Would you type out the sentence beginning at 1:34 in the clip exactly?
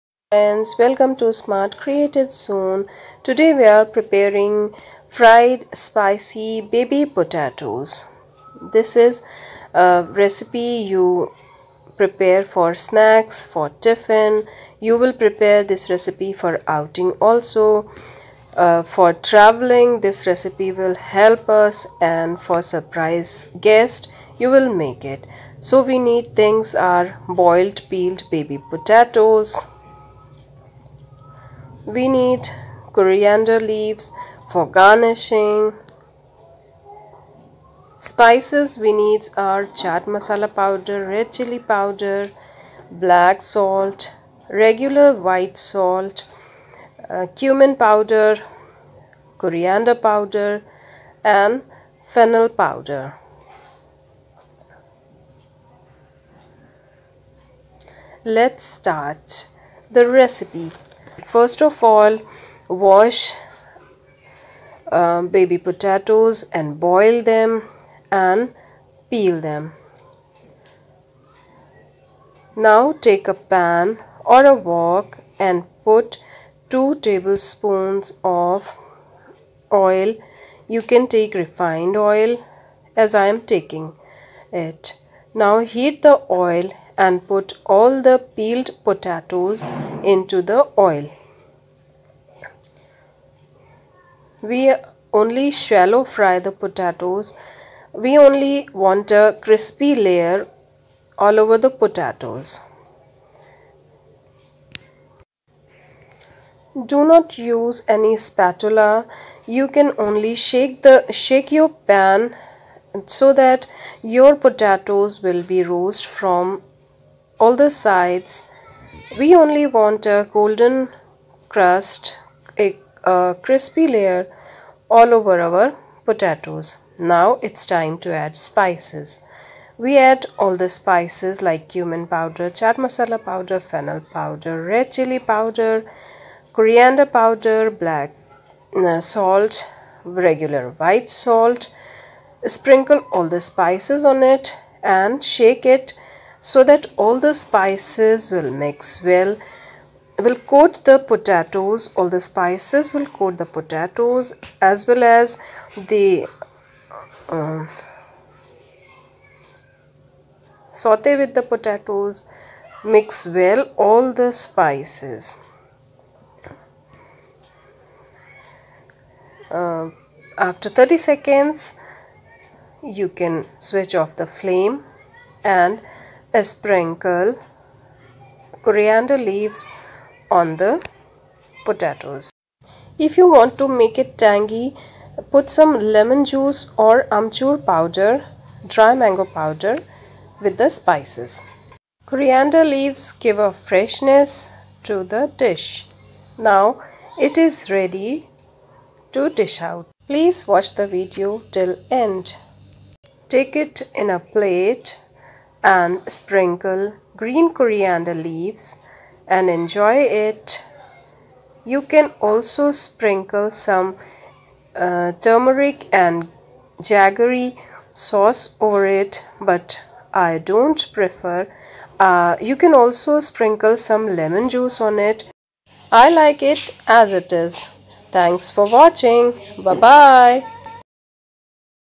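We only shallow fry the potatoes.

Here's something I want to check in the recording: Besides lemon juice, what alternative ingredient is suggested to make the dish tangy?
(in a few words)
amchur powder.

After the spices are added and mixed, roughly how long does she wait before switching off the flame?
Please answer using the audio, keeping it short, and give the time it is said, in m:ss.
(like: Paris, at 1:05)
30 seconds, at 2:50.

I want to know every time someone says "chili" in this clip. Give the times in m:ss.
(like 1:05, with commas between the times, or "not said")
0:41, 2:14.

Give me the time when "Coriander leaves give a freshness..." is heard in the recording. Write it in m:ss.
3:12.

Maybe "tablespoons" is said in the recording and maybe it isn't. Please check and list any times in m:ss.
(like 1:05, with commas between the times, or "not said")
1:17.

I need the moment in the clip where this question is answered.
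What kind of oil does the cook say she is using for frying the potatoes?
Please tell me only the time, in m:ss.
1:21.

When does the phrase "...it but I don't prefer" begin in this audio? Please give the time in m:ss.
3:38.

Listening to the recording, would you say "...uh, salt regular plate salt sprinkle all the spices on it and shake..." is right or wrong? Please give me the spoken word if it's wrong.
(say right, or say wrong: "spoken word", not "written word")
wrong: "white", not "plate".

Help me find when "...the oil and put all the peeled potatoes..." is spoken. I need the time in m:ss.
1:26.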